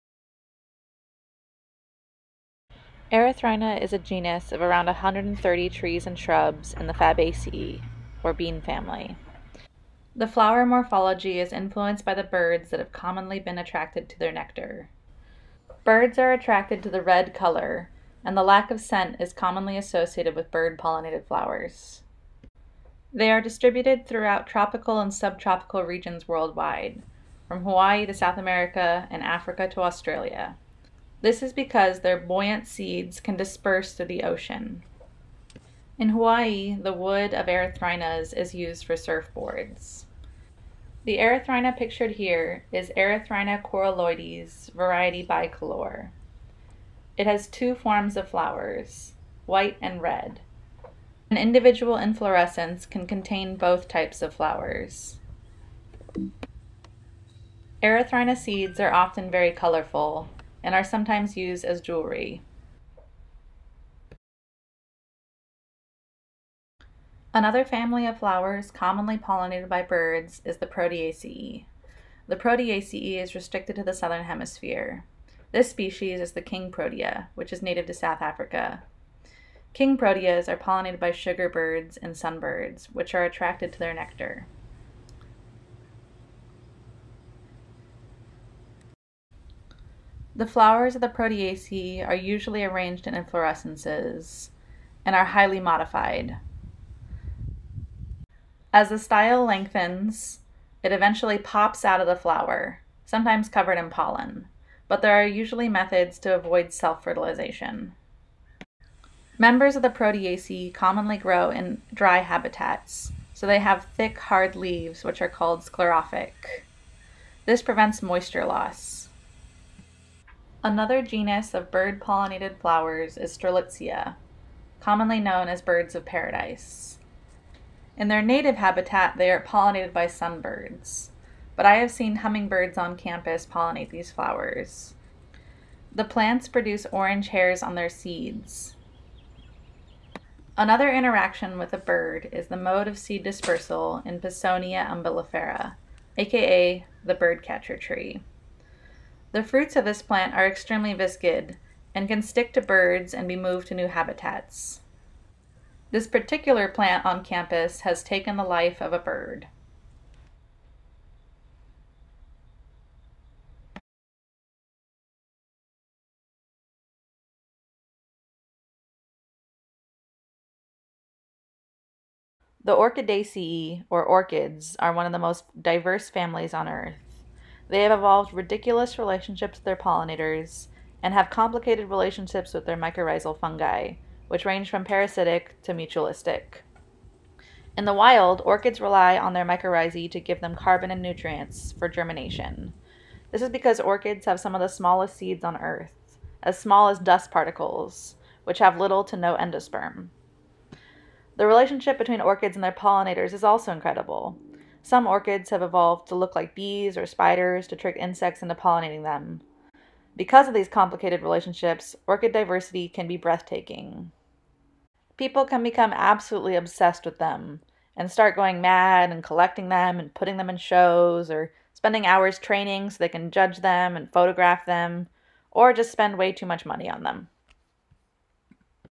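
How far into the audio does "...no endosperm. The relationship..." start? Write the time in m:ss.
3:19.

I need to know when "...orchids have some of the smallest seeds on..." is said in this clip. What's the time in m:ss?
3:13.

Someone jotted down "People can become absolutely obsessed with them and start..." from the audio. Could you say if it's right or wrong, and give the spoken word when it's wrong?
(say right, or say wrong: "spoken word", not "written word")
right.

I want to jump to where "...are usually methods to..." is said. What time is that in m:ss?
1:45.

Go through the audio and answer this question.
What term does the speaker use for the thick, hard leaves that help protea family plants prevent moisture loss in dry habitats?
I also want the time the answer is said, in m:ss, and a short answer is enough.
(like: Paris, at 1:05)
sclerophic, at 1:55.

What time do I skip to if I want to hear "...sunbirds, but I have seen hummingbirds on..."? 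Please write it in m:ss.
2:10.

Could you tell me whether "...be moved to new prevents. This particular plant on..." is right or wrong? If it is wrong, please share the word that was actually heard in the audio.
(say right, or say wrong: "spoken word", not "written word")
wrong: "habitats", not "prevents".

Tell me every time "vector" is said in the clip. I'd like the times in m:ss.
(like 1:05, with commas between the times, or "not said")
not said.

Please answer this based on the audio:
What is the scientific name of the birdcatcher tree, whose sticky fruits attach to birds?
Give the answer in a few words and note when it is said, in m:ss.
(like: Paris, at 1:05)
Pisonia umbellifera, at 2:24.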